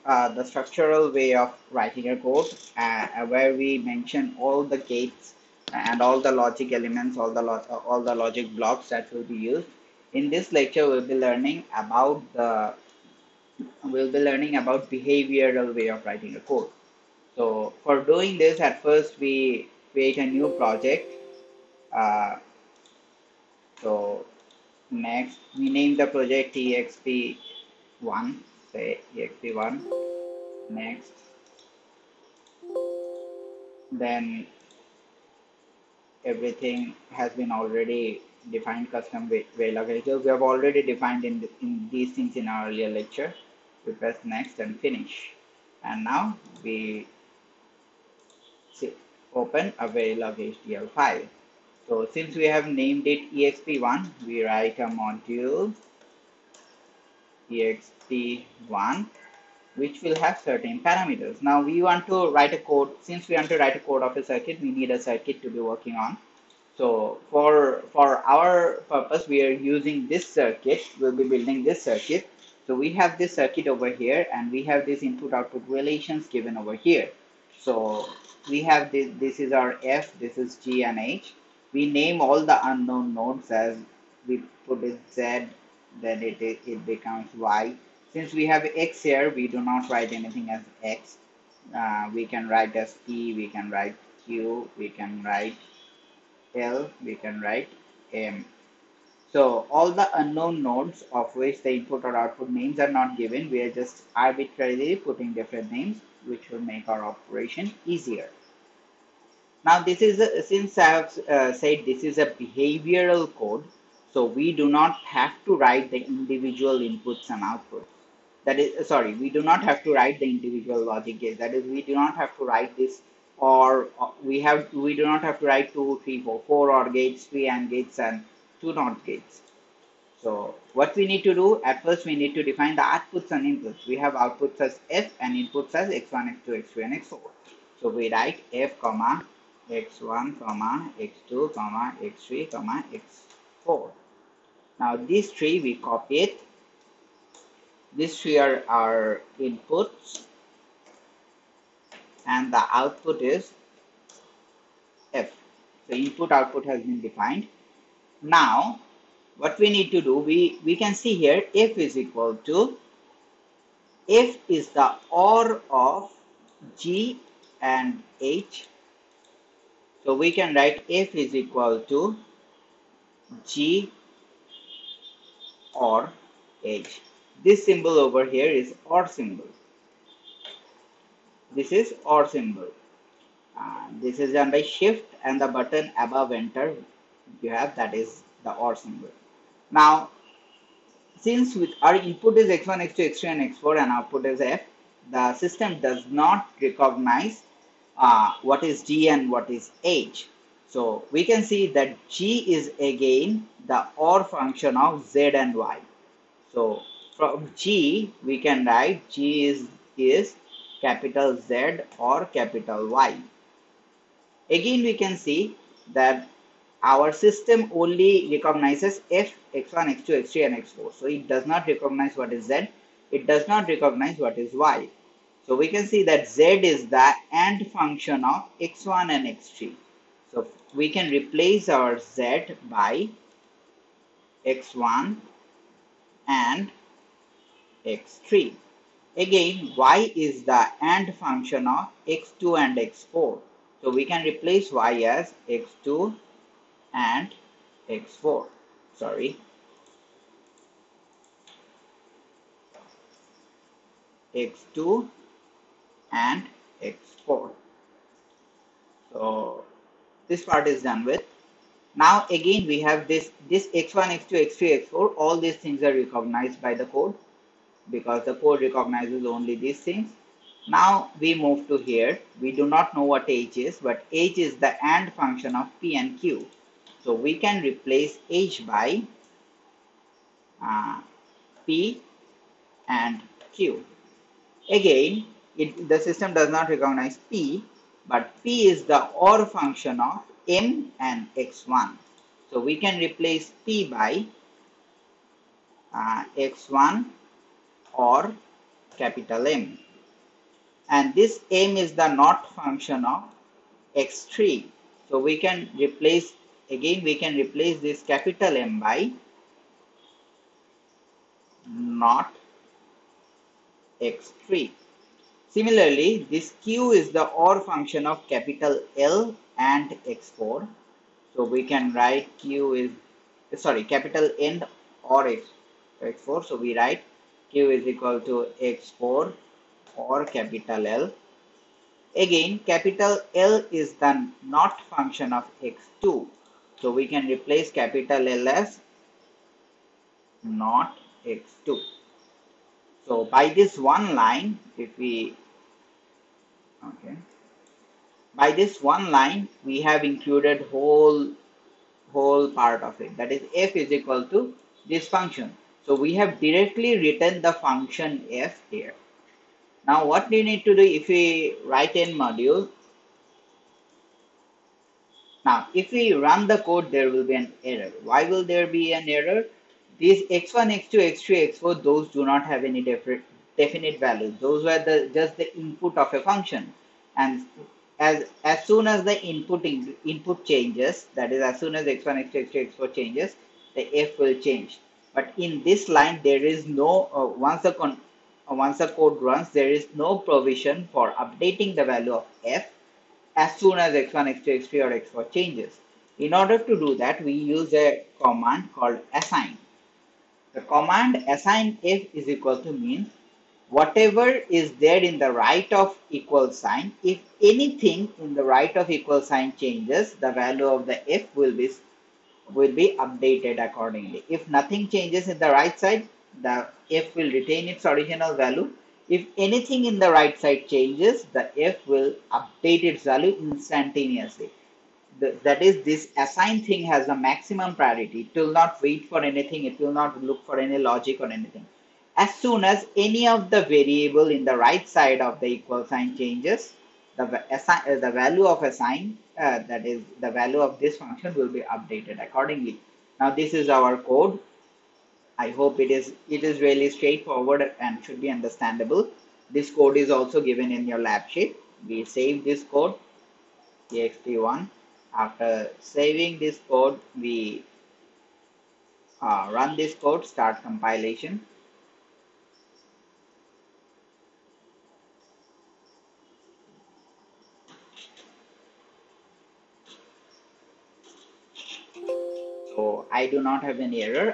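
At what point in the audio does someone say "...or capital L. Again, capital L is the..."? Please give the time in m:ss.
5:29.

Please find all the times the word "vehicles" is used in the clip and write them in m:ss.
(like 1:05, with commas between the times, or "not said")
0:39.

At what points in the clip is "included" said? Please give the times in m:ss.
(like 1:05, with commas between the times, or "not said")
5:50.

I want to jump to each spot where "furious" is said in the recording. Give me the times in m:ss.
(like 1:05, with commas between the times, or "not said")
not said.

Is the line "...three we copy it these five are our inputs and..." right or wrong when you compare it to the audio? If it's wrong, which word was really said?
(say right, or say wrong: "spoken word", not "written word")
wrong: "three", not "five".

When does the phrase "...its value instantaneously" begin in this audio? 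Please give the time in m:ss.
7:02.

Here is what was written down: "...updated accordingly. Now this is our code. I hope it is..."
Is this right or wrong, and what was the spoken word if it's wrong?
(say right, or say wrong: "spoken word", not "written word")
right.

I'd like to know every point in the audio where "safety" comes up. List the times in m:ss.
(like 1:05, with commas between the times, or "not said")
not said.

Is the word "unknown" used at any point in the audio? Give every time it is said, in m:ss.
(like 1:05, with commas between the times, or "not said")
1:22, 1:40.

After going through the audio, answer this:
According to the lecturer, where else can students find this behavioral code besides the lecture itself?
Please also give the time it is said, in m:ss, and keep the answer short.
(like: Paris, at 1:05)
lab sheet, at 7:30.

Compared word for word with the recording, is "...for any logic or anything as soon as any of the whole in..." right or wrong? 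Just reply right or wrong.
wrong.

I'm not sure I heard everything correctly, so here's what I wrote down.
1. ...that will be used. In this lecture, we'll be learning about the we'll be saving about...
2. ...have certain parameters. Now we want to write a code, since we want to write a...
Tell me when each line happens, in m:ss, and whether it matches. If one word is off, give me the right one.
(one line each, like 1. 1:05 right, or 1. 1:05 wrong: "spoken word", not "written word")
1. 0:08 wrong: "learning", not "saving"
2. 1:00 right.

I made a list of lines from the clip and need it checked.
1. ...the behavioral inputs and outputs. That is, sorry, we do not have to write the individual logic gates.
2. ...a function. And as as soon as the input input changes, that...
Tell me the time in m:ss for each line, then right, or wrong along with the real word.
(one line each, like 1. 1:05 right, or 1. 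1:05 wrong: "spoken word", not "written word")
1. 1:55 wrong: "individual", not "behavioral"
2. 6:16 right.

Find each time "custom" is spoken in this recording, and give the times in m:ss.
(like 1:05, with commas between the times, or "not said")
0:38.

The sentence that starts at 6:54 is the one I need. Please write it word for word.
If nothing changes in the right side, the f will retain its original value.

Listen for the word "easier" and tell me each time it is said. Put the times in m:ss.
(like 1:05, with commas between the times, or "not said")
1:47.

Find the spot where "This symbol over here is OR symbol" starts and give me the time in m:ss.
2:57.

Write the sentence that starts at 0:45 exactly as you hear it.
And now we see, open a Verilog HDL file.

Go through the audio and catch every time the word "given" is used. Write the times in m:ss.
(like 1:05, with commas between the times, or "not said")
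1:16, 1:43, 7:30.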